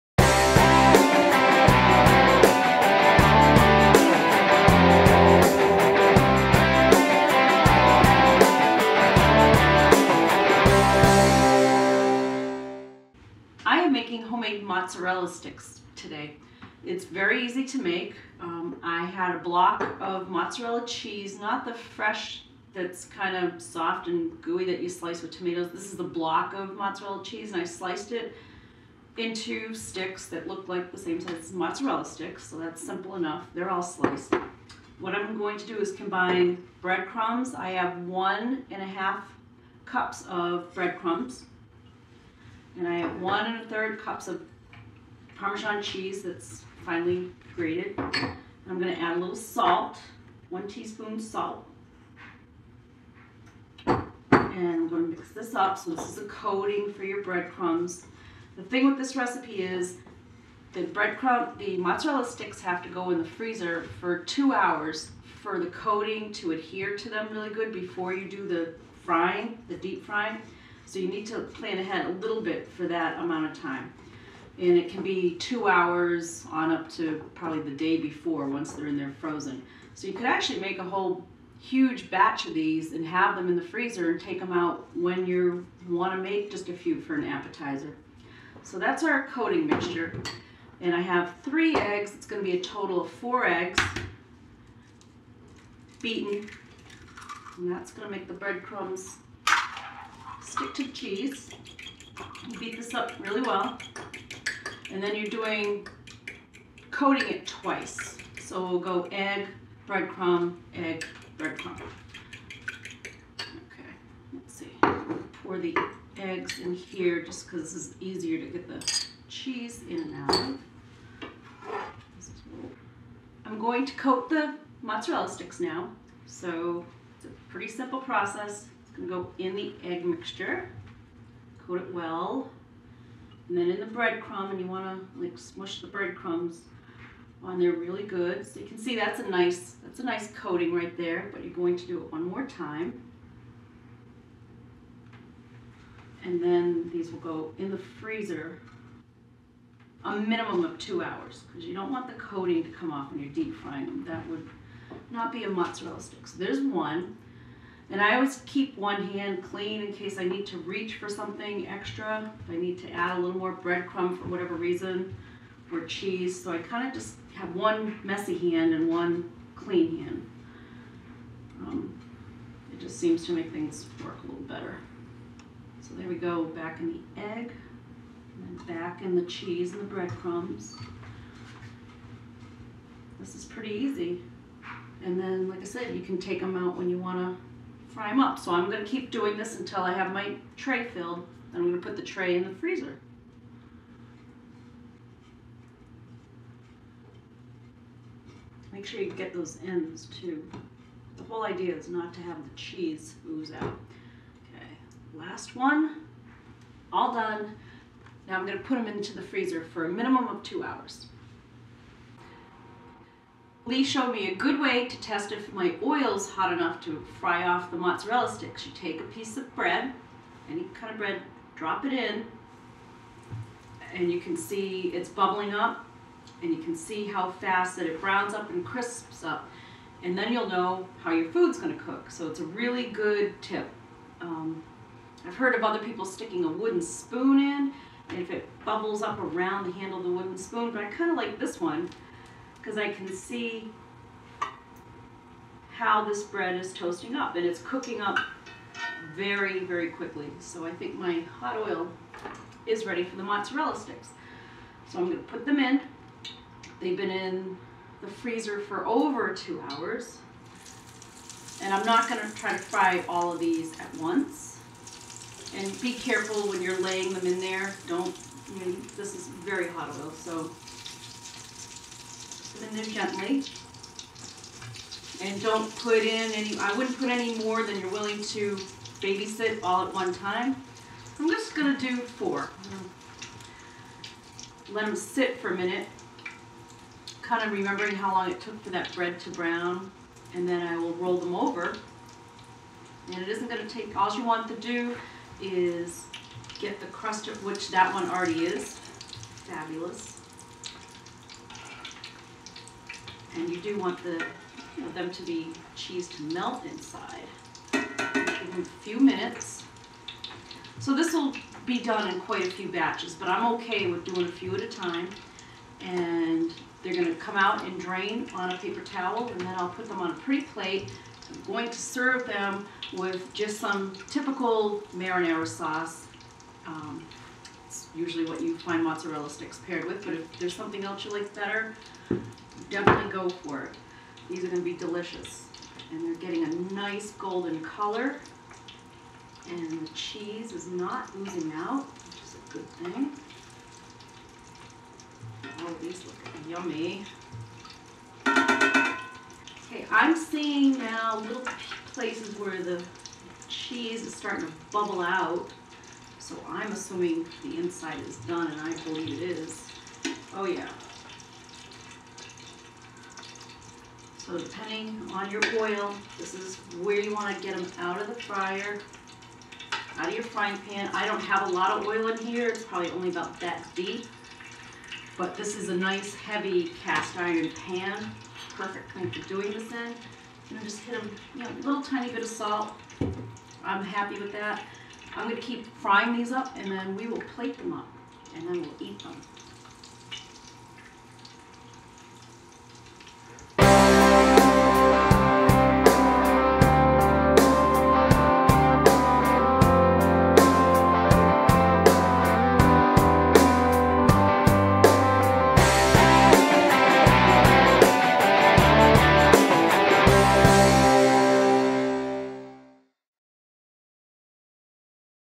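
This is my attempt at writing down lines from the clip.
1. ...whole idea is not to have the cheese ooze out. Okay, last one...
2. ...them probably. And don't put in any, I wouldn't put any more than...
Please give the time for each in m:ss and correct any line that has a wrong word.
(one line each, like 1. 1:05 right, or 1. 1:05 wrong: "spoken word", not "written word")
1. 3:21 right
2. 4:32 wrong: "gently", not "probably".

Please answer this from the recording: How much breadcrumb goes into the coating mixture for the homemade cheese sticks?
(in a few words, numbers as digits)
1 1/2 cups.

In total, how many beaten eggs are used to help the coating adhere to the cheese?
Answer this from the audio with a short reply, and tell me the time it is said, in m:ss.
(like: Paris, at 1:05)
4, at 1:33.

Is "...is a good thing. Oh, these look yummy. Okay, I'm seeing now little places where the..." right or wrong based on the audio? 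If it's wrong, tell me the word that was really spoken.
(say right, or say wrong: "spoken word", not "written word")
right.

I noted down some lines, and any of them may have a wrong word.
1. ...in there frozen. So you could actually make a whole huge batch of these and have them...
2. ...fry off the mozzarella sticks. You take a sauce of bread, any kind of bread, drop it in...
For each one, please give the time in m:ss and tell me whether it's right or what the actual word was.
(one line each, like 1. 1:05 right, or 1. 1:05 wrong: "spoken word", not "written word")
1. 1:18 right
2. 3:37 wrong: "piece", not "sauce".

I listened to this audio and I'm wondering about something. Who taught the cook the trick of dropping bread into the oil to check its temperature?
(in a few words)
Lee.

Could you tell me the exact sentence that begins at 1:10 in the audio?
So you need to plan ahead a little bit for that amount of time.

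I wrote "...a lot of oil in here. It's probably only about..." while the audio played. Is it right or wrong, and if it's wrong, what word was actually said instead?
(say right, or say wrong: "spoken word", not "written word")
right.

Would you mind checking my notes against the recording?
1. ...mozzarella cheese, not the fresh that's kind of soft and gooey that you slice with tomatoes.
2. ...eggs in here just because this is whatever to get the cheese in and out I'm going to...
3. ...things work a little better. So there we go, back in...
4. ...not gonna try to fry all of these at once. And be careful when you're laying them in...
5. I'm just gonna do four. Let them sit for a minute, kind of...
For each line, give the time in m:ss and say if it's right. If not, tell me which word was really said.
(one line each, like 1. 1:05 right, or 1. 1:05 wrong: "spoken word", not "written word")
1. 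0:20 right
2. 1:56 wrong: "easier", not "whatever"
3. 2:53 right
4. 4:21 right
5. 4:41 right.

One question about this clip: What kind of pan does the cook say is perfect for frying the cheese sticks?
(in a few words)
cast iron pan.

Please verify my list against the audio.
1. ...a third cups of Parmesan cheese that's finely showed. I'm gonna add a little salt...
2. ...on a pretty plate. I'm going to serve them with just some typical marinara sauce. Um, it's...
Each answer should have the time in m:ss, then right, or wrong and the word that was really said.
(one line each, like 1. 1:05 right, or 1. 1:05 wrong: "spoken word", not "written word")
1. 0:43 wrong: "grated", not "showed"
2. 5:19 right.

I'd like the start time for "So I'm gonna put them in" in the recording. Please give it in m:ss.
4:14.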